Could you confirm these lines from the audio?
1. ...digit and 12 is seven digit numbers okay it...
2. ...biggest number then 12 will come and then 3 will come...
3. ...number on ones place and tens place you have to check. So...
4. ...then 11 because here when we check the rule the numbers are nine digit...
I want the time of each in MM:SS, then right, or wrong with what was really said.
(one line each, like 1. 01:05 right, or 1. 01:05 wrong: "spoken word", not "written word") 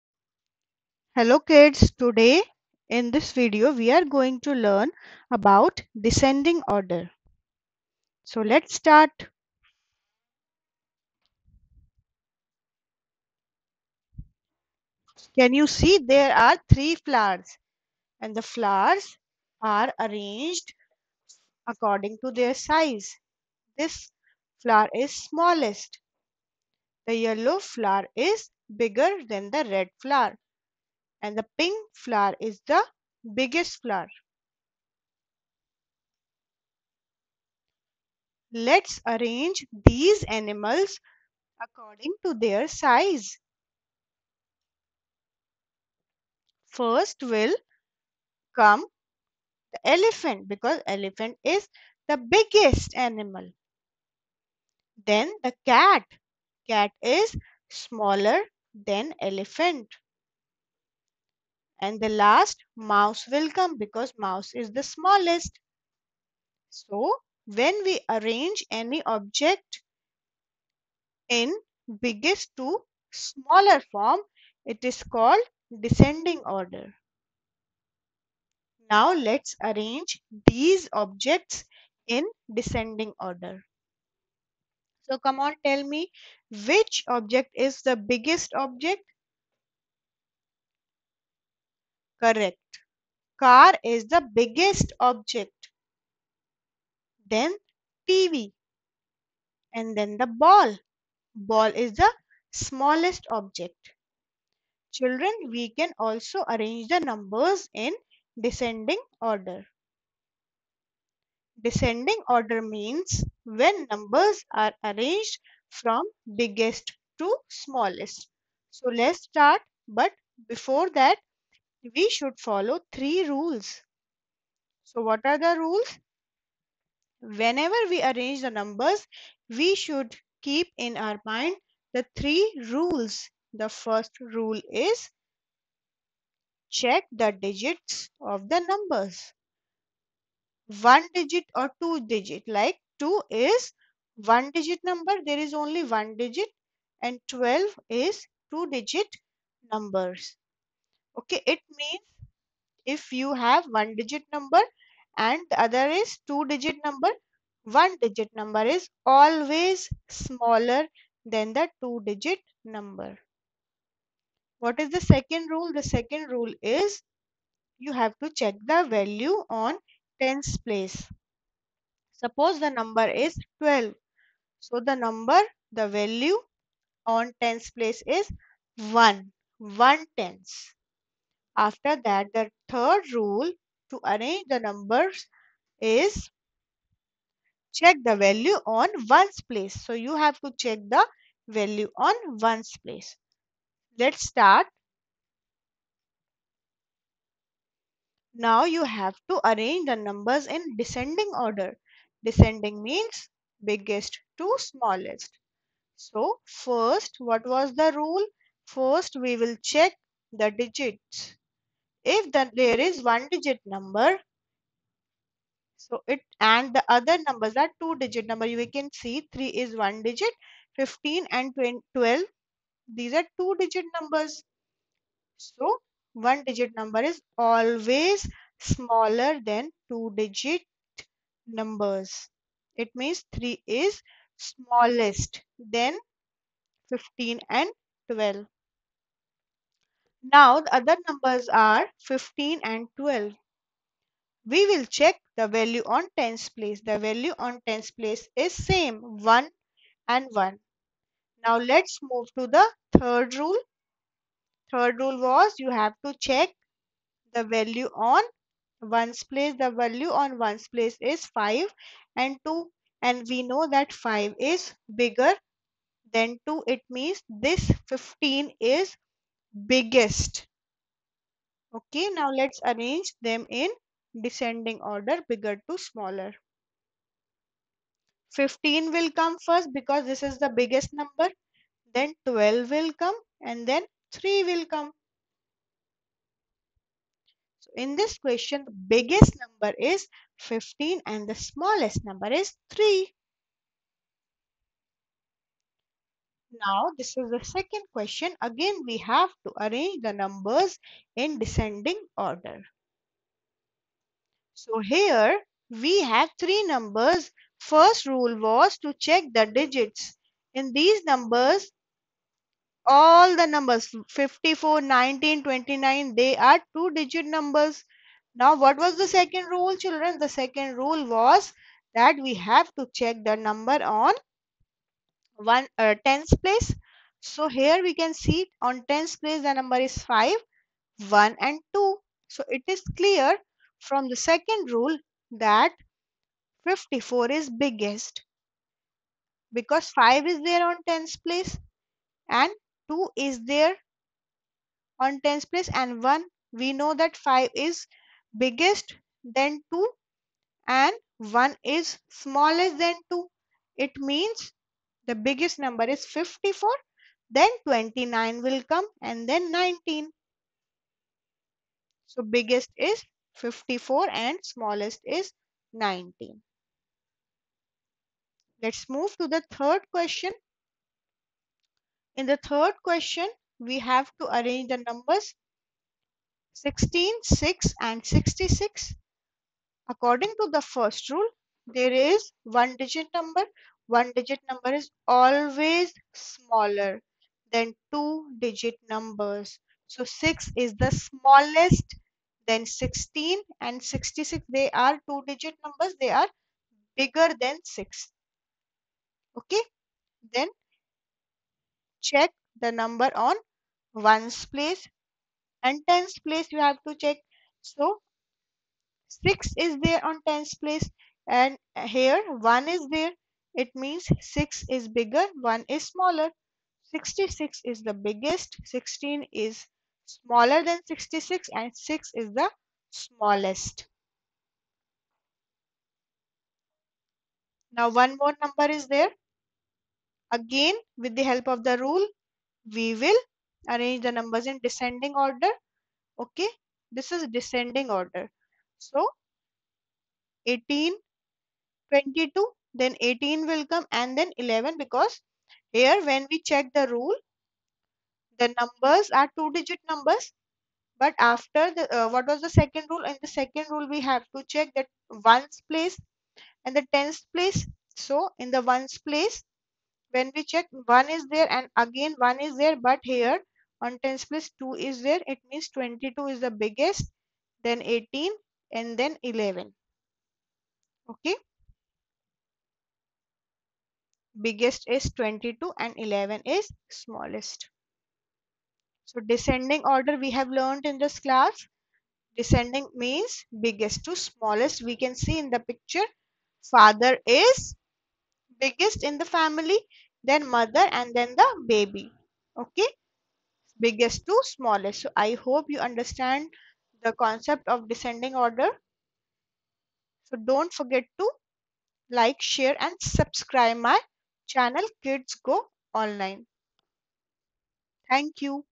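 1. 02:26 wrong: "two", not "seven"
2. 04:40 right
3. 06:42 right
4. 07:24 wrong: "two", not "nine".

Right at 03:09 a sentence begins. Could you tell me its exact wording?
So you have to check the value on ones place.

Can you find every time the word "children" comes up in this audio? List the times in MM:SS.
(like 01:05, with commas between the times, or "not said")
01:44, 05:19.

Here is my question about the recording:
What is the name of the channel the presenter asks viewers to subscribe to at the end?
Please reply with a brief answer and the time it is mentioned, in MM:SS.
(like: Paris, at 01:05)
Kids Go Online, at 08:25.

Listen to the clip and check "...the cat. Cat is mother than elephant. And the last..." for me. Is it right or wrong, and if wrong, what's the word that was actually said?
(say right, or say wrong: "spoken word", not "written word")
wrong: "smaller", not "mother".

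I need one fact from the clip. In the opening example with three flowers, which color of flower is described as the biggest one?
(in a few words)
Pink.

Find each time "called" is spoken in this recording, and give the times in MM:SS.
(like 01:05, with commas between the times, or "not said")
01:15.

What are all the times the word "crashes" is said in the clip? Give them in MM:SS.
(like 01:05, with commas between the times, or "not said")
not said.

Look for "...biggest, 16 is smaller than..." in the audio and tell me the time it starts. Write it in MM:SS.
06:57.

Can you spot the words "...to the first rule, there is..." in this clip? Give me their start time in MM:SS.
06:20.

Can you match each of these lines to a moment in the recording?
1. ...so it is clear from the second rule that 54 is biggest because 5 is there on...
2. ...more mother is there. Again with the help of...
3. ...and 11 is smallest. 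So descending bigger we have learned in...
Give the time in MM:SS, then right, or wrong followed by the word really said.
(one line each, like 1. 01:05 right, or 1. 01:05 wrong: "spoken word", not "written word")
1. 05:32 right
2. 07:08 wrong: "number", not "mother"
3. 07:55 wrong: "order", not "bigger".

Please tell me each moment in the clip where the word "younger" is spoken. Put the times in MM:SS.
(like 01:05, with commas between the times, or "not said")
not said.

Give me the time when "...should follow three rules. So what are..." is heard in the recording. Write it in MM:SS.
02:02.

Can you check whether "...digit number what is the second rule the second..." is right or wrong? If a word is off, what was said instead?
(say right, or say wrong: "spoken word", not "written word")
right.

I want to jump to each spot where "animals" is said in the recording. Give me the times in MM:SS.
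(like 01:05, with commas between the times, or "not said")
00:40, 00:52.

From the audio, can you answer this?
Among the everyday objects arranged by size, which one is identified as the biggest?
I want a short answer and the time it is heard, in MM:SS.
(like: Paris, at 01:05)
Car, at 01:33.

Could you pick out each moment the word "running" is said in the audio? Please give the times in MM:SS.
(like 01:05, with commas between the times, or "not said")
not said.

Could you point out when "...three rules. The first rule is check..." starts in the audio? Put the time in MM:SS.
02:12.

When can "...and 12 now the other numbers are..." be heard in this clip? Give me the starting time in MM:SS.
03:57.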